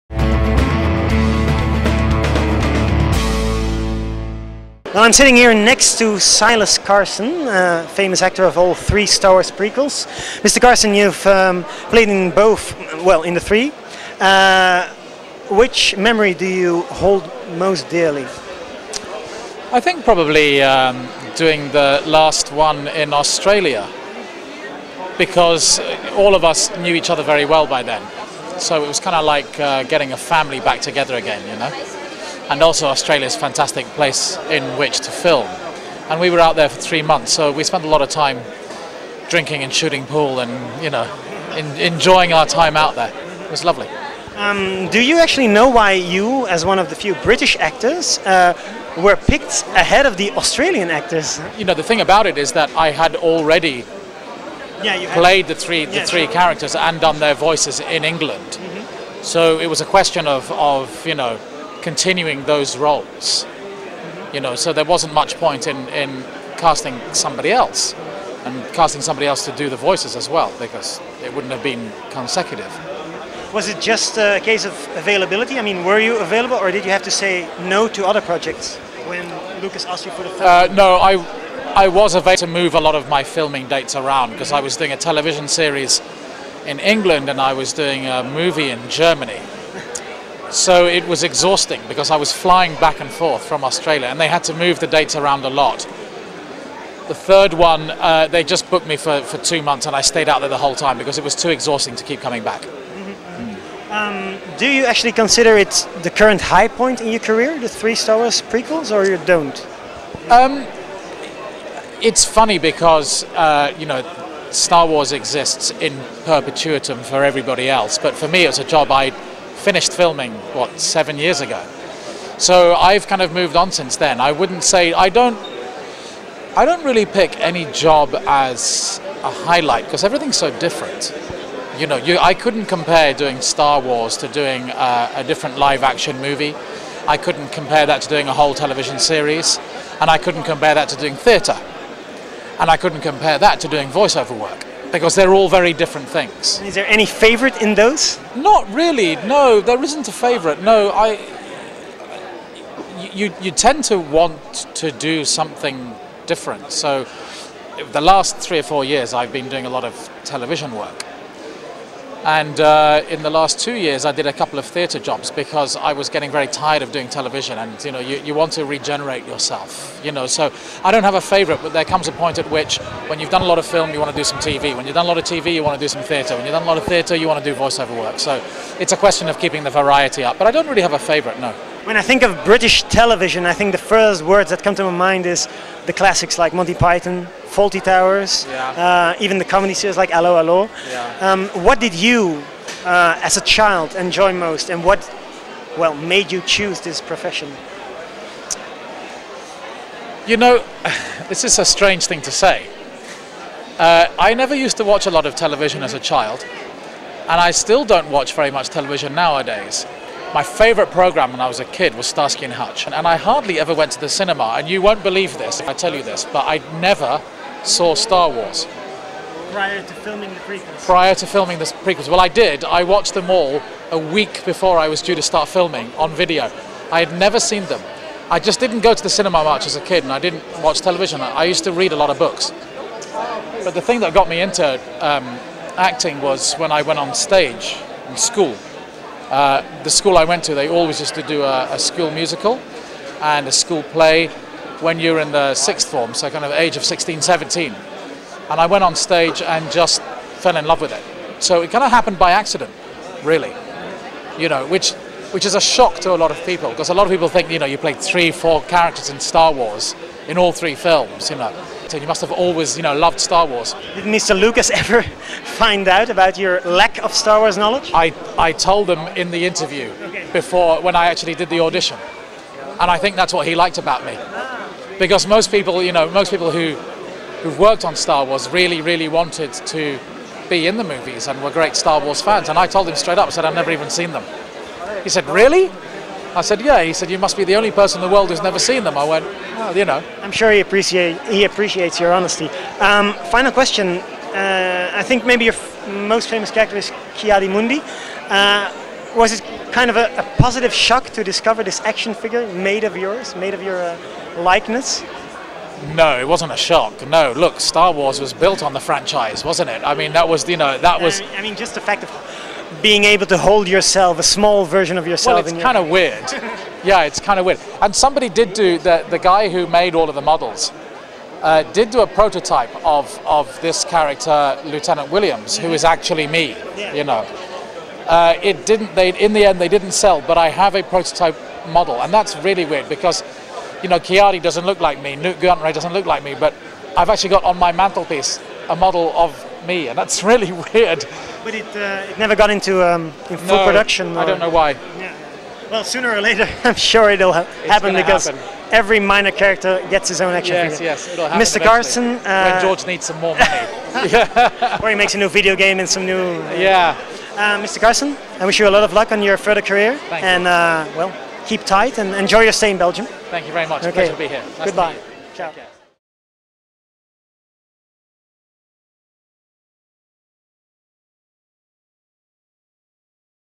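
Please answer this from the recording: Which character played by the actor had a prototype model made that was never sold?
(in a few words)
Lieutenant Williams.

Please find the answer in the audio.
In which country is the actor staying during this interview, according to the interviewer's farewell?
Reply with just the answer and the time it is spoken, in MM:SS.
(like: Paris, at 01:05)
Belgium, at 06:02.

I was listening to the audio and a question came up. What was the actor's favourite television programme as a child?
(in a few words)
Starsky and Hutch.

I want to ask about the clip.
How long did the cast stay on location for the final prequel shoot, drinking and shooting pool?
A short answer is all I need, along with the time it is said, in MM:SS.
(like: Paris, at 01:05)
3 months, at 00:36.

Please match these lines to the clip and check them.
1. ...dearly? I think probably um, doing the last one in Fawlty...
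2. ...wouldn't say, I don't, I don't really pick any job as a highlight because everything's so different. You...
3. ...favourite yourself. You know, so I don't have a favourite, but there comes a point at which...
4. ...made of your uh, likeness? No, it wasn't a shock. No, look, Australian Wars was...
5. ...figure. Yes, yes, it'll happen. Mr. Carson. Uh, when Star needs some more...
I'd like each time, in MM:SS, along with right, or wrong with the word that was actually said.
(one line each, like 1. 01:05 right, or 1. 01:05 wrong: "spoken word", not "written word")
1. 00:17 wrong: "Australia", not "Fawlty"
2. 02:04 right
3. 02:48 wrong: "regenerate", not "favourite"
4. 05:03 wrong: "Star", not "Australian"
5. 05:50 wrong: "George", not "Star".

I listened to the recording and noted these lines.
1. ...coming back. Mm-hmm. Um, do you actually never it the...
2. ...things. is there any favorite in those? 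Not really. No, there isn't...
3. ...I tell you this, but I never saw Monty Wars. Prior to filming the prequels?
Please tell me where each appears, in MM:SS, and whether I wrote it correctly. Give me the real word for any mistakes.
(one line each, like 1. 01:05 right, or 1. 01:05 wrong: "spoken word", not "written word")
1. 01:42 wrong: "consider", not "never"
2. 02:26 right
3. 03:35 wrong: "Star", not "Monty".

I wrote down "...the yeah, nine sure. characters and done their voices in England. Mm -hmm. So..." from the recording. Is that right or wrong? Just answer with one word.
wrong.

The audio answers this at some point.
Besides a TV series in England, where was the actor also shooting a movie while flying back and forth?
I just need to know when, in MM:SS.
01:28.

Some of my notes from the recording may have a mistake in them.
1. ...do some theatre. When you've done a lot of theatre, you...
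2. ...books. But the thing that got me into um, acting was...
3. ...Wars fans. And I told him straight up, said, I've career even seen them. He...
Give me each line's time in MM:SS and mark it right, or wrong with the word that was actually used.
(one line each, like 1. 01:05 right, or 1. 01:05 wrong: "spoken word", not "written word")
1. 02:55 right
2. 03:52 right
3. 04:41 wrong: "never", not "career".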